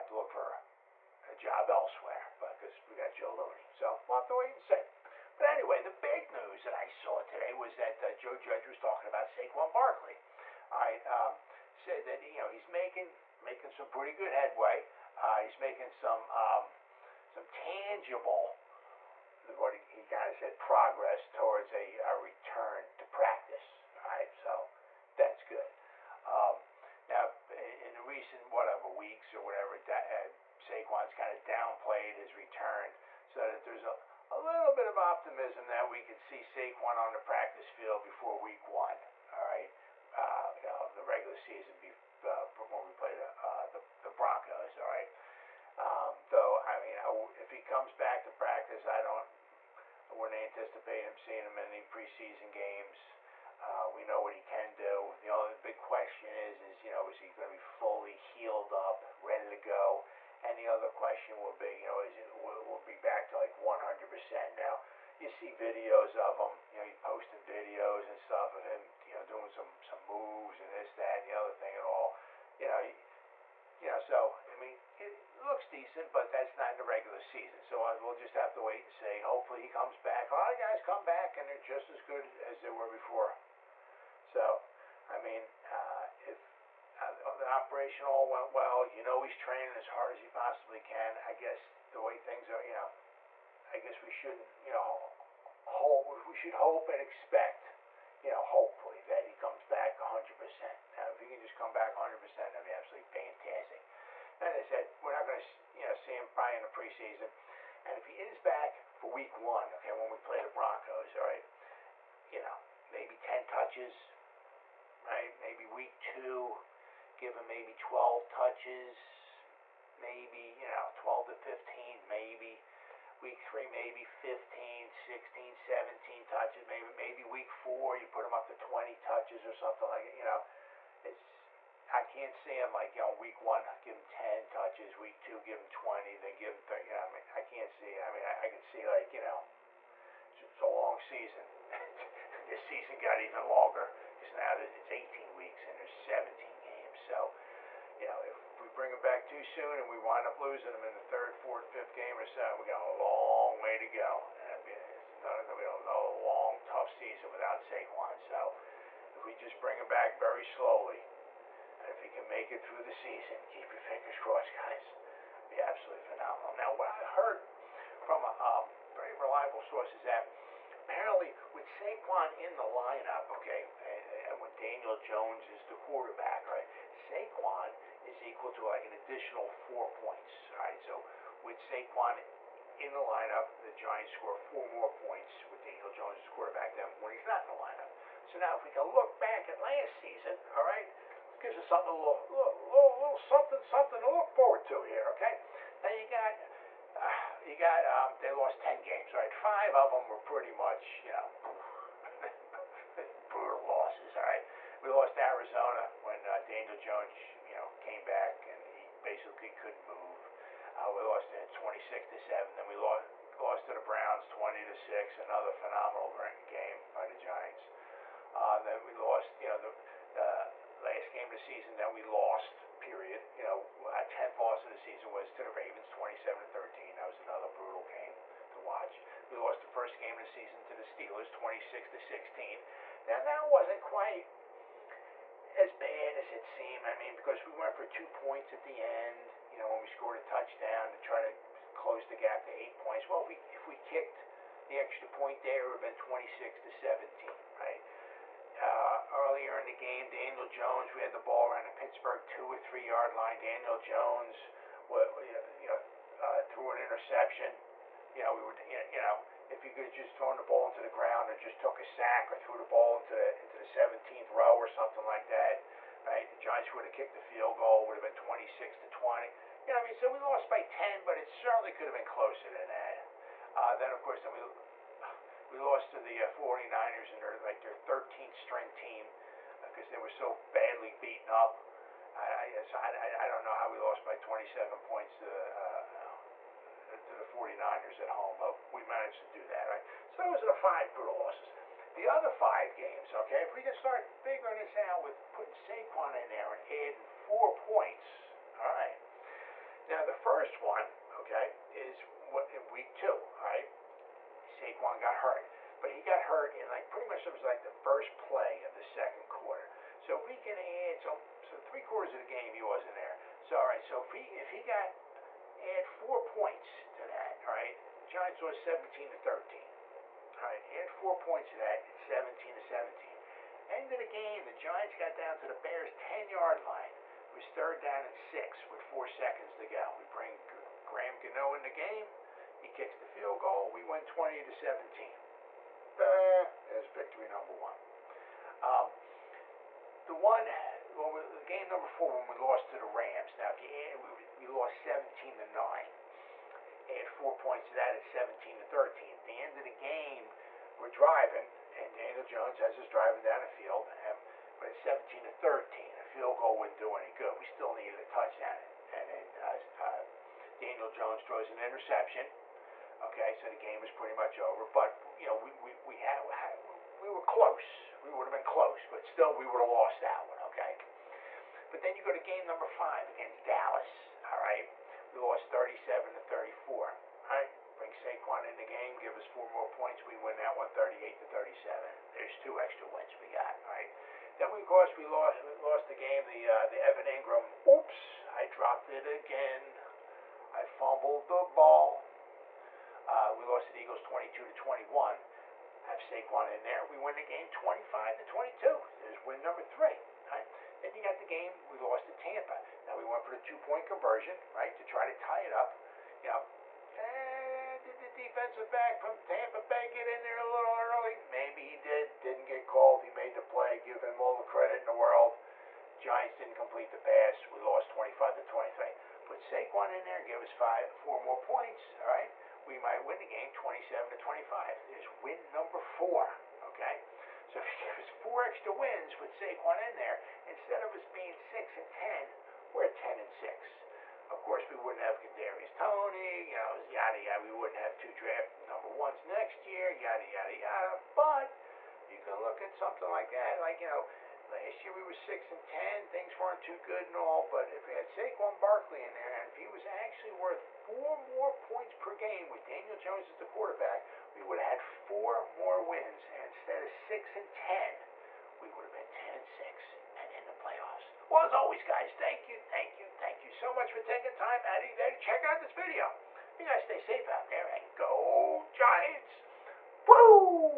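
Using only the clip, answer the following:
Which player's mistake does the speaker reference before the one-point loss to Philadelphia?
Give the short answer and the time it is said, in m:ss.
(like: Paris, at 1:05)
Evan Engram, at 6:26.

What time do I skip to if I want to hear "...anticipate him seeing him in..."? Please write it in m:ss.
0:50.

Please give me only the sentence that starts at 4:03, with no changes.
Well, if we, if we kicked the extra point there, it would have been 26 to 17, right?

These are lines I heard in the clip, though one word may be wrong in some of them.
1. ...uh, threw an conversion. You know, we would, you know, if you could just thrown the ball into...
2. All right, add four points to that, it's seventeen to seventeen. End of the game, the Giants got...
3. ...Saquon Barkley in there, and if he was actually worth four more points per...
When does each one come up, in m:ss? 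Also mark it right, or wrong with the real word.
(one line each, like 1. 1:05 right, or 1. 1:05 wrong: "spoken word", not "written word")
1. 4:16 wrong: "interception", not "conversion"
2. 5:20 right
3. 7:28 right.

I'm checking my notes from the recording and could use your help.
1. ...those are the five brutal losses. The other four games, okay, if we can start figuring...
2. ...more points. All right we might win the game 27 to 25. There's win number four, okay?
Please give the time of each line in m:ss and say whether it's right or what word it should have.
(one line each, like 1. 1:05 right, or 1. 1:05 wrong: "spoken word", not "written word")
1. 4:50 wrong: "five", not "four"
2. 7:01 right.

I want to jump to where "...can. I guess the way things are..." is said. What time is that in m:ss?
1:30.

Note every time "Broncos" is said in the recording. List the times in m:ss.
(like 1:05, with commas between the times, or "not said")
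0:44, 1:50.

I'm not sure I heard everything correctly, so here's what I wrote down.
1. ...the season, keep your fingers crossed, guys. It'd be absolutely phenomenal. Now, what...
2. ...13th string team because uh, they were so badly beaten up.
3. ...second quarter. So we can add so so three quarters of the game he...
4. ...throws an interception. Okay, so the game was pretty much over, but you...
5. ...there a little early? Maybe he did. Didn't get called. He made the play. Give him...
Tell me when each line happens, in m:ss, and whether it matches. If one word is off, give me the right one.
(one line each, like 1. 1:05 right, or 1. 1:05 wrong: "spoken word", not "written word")
1. 2:42 right
2. 4:37 right
3. 5:08 right
4. 6:01 right
5. 6:50 right.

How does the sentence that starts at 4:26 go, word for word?
The Giants would have kicked the field goal, would have been 26 to 20.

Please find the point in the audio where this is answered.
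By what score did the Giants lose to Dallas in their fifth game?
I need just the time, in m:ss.
6:15.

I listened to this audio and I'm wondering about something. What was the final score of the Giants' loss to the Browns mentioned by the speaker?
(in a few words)
20 to 6.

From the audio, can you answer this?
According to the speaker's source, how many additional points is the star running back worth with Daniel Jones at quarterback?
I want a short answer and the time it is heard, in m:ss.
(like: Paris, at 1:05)
4, at 2:58.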